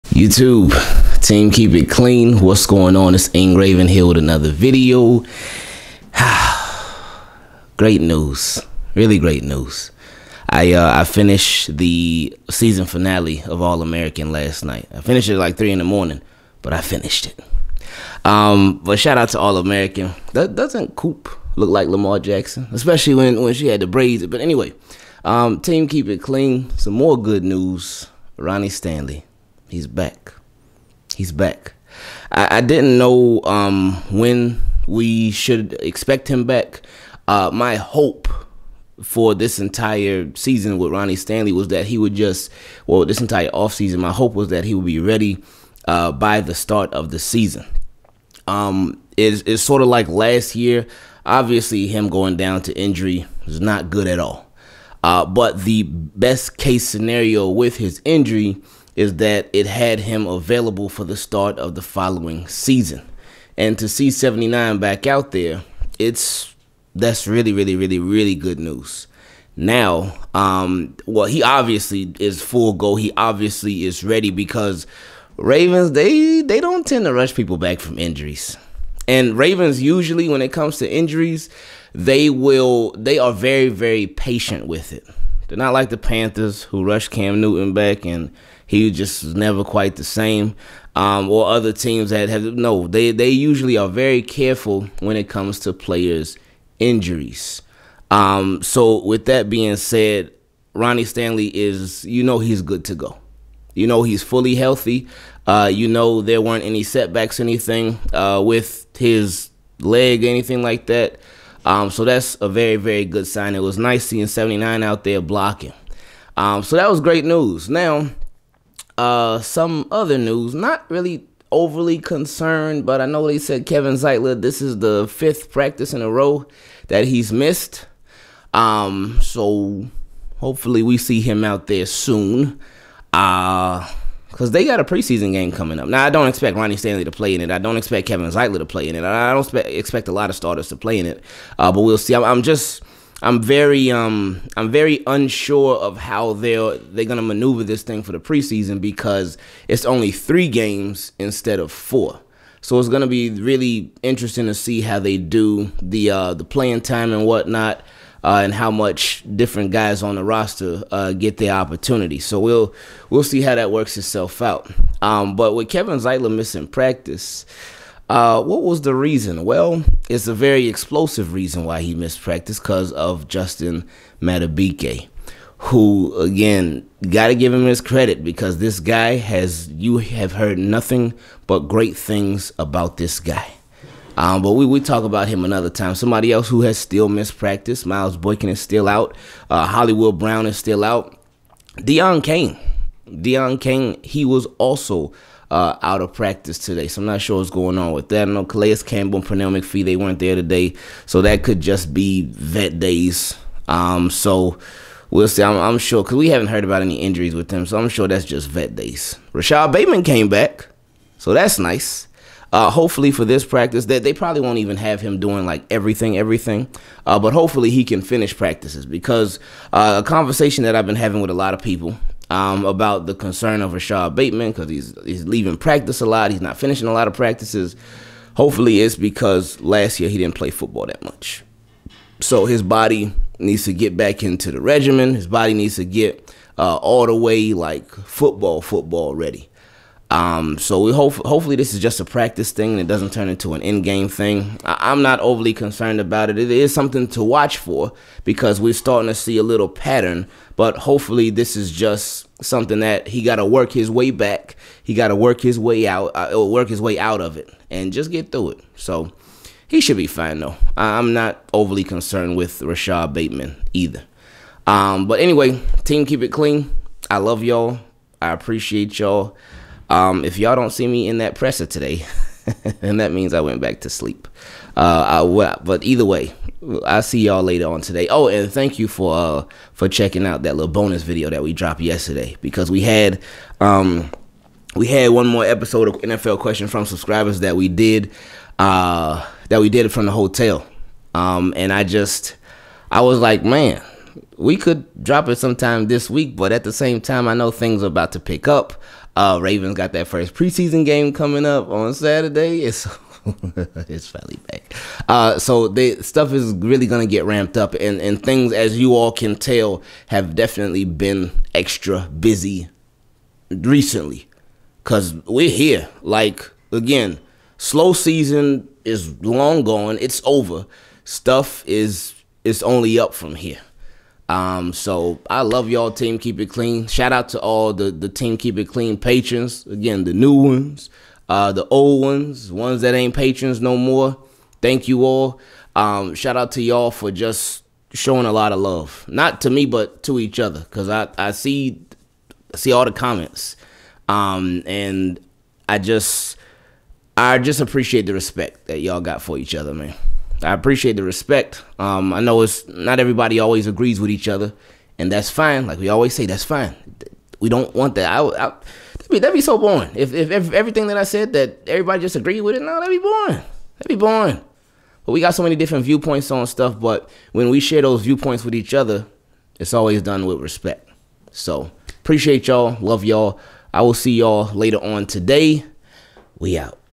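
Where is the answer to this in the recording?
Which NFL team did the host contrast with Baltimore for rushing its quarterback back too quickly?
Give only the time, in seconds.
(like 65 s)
85 s.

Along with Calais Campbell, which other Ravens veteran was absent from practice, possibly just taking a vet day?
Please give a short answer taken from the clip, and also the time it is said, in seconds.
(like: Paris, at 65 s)
Pernell McPhee, at 199 s.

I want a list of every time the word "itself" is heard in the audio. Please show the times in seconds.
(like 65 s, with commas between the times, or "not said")
163 s.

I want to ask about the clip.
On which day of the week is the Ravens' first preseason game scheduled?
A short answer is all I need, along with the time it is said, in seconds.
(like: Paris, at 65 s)
Saturday, at 301 s.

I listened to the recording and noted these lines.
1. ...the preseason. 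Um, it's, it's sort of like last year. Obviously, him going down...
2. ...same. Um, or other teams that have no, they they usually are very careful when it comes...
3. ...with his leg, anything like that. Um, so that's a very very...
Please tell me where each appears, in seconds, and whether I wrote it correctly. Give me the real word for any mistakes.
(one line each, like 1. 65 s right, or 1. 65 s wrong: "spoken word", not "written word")
1. 47 s wrong: "season", not "preseason"
2. 90 s right
3. 108 s right.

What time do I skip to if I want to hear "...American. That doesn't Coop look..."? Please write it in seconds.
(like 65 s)
19 s.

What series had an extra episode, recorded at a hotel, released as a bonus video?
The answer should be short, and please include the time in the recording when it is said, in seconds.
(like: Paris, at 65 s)
NFL question from subscribers, at 286 s.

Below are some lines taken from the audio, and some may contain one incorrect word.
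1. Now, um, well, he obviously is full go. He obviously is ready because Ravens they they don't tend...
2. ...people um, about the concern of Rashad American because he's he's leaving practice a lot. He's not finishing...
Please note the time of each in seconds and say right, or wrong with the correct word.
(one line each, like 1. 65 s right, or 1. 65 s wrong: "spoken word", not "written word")
1. 69 s right
2. 221 s wrong: "Bateman", not "American".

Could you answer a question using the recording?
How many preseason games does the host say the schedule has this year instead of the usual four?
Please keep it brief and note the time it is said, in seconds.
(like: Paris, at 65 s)
3, at 150 s.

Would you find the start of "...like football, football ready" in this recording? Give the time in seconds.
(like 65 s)
237 s.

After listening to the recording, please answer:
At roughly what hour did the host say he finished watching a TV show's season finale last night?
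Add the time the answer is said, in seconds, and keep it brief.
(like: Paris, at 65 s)
3 in the morning, at 15 s.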